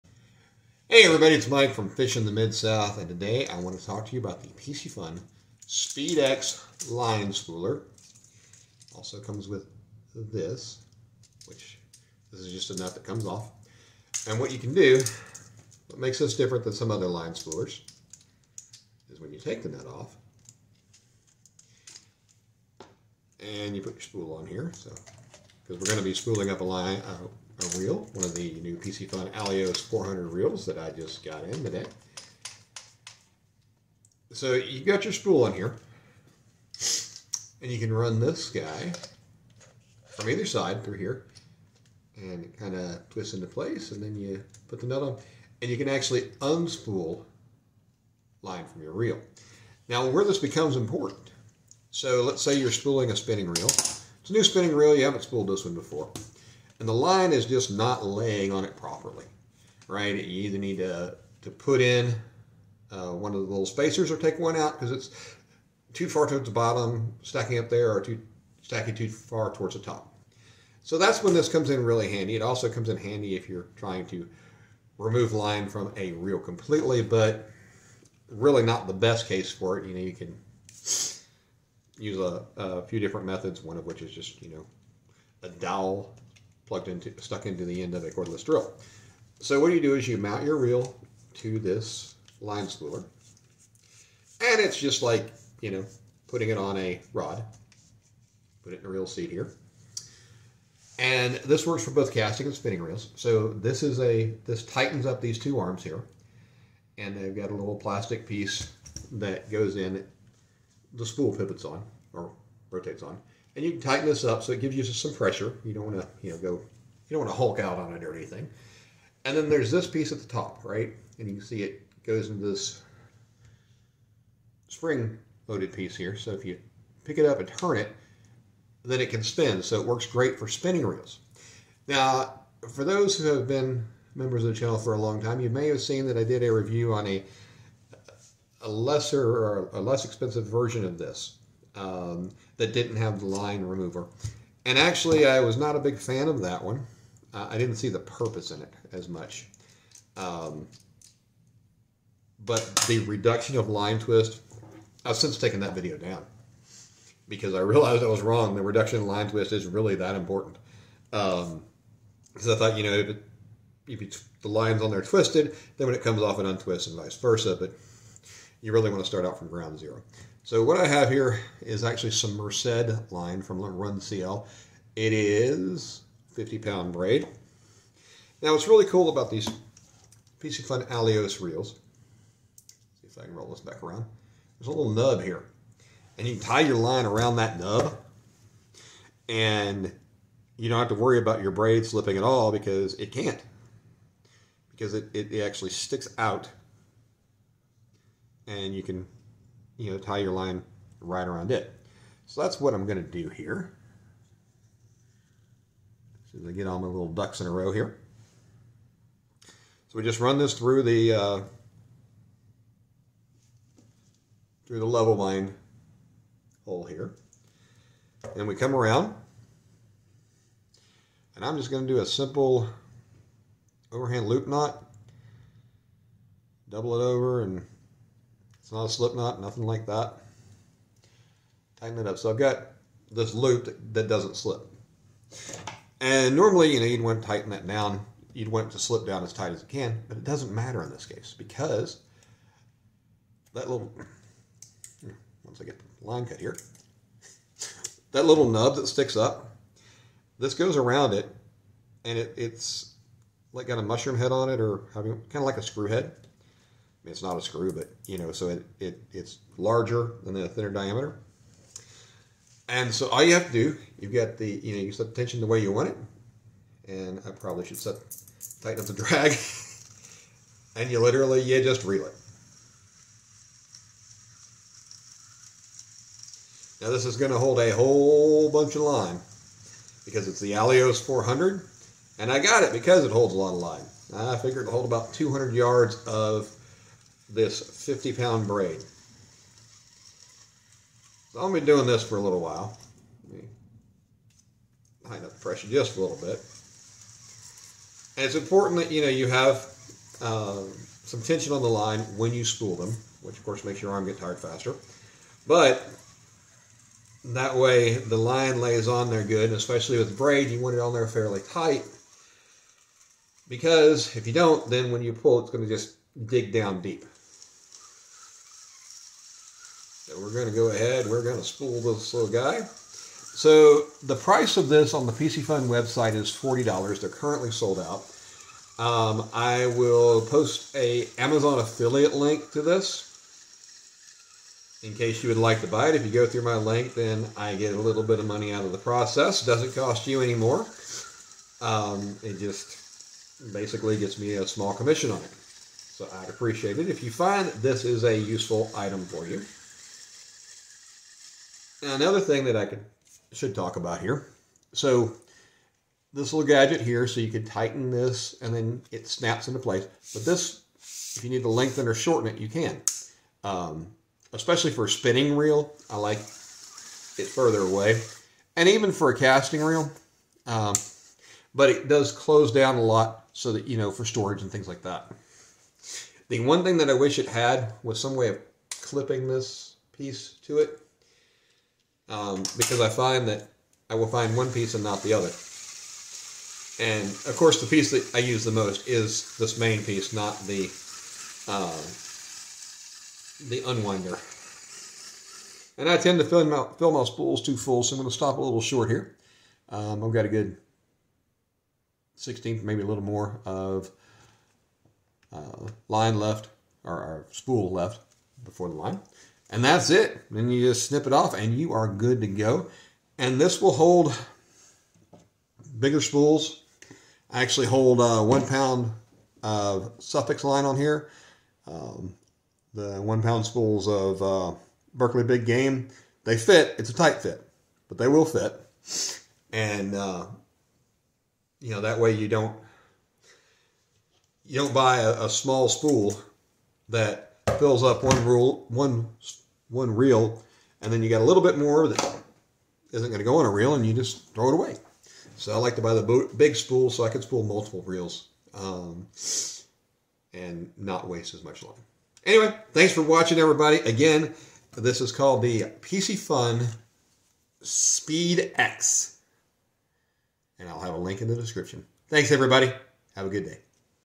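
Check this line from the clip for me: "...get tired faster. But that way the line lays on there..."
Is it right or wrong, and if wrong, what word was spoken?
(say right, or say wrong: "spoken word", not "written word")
right.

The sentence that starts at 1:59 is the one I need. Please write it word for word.
And then there's this piece at the top, right?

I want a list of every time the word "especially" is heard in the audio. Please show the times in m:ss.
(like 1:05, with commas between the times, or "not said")
5:09, 6:04.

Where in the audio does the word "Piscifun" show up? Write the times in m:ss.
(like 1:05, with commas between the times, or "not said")
0:04, 5:25, 7:35.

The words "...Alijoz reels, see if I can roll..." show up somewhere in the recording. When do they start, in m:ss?
3:00.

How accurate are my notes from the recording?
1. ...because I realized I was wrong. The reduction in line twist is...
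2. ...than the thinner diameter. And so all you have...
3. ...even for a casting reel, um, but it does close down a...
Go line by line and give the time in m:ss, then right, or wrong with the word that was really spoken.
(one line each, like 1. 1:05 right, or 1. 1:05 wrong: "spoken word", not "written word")
1. 2:37 right
2. 4:20 right
3. 6:08 right.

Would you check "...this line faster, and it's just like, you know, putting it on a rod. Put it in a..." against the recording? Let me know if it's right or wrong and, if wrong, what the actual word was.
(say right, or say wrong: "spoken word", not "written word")
wrong: "spooler", not "faster".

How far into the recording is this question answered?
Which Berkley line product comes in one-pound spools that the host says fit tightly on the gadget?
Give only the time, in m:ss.
7:04.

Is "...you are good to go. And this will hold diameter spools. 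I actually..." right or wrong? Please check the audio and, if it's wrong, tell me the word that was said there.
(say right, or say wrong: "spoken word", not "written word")
wrong: "bigger", not "diameter".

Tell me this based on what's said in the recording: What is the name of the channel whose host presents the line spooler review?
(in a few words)
Fishing the Midsouth.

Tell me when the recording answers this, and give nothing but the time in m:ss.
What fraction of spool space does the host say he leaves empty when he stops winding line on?
6:42.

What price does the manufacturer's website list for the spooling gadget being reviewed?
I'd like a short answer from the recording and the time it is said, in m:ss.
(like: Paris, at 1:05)
$40, at 5:26.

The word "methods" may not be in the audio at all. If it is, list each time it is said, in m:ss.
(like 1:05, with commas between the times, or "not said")
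1:23.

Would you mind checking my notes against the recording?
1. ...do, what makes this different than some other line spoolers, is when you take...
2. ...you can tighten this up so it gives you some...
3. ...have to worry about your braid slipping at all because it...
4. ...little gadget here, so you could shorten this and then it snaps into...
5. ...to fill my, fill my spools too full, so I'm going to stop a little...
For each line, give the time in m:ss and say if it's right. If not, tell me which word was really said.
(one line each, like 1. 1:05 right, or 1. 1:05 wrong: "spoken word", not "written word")
1. 0:14 right
2. 1:53 right
3. 3:10 right
4. 5:56 wrong: "tighten", not "shorten"
5. 6:36 right.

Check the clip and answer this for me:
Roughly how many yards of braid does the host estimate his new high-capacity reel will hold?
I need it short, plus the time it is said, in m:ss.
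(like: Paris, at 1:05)
200 yards, at 4:45.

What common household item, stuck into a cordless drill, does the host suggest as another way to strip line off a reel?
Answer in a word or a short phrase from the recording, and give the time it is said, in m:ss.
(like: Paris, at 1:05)
A dowel, at 1:25.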